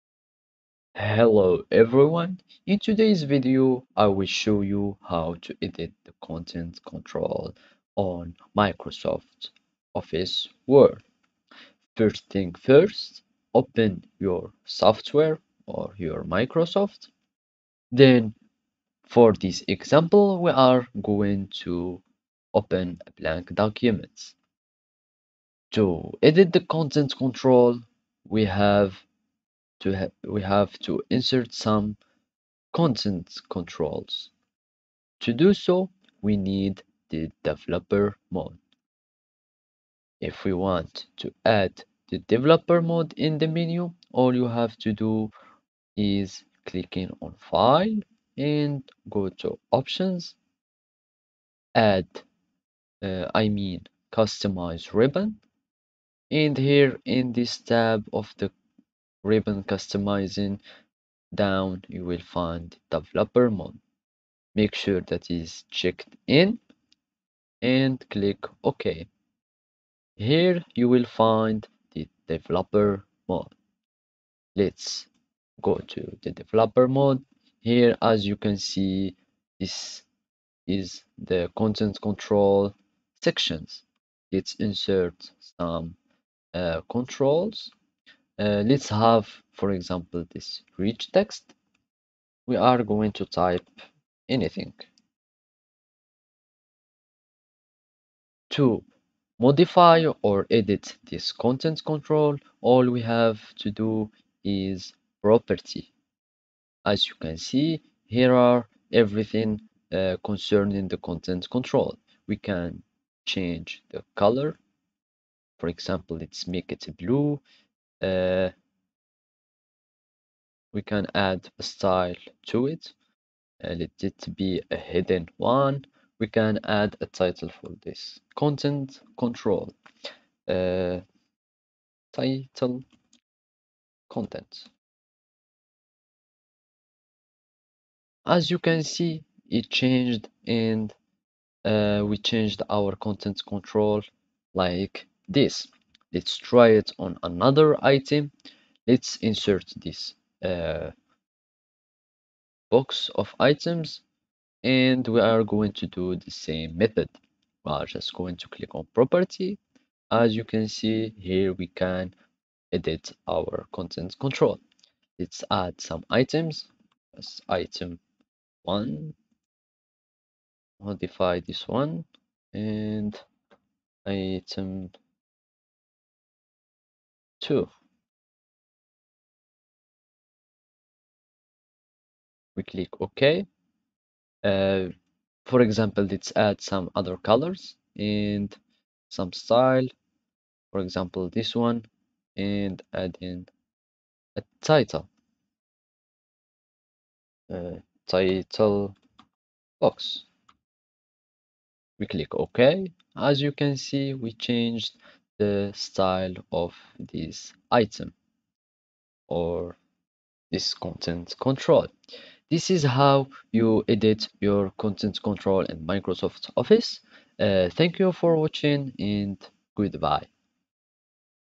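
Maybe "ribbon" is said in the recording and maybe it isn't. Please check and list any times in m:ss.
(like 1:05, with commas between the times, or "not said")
0:54, 0:59.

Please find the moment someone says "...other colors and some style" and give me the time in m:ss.
3:06.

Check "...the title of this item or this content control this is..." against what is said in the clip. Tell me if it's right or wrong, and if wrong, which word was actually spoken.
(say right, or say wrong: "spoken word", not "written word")
wrong: "style", not "title".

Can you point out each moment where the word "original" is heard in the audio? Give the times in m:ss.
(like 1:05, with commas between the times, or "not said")
not said.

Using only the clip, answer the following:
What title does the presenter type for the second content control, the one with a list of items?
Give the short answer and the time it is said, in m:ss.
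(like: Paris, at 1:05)
Title box, at 3:18.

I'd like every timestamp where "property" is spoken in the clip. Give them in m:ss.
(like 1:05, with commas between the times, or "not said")
1:45, 2:38.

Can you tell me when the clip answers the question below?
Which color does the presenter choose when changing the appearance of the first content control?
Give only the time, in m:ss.
1:56.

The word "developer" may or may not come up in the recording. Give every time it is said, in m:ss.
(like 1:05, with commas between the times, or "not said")
0:37, 0:42, 1:02, 1:12, 1:16.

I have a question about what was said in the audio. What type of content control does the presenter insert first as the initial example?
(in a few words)
Rich text.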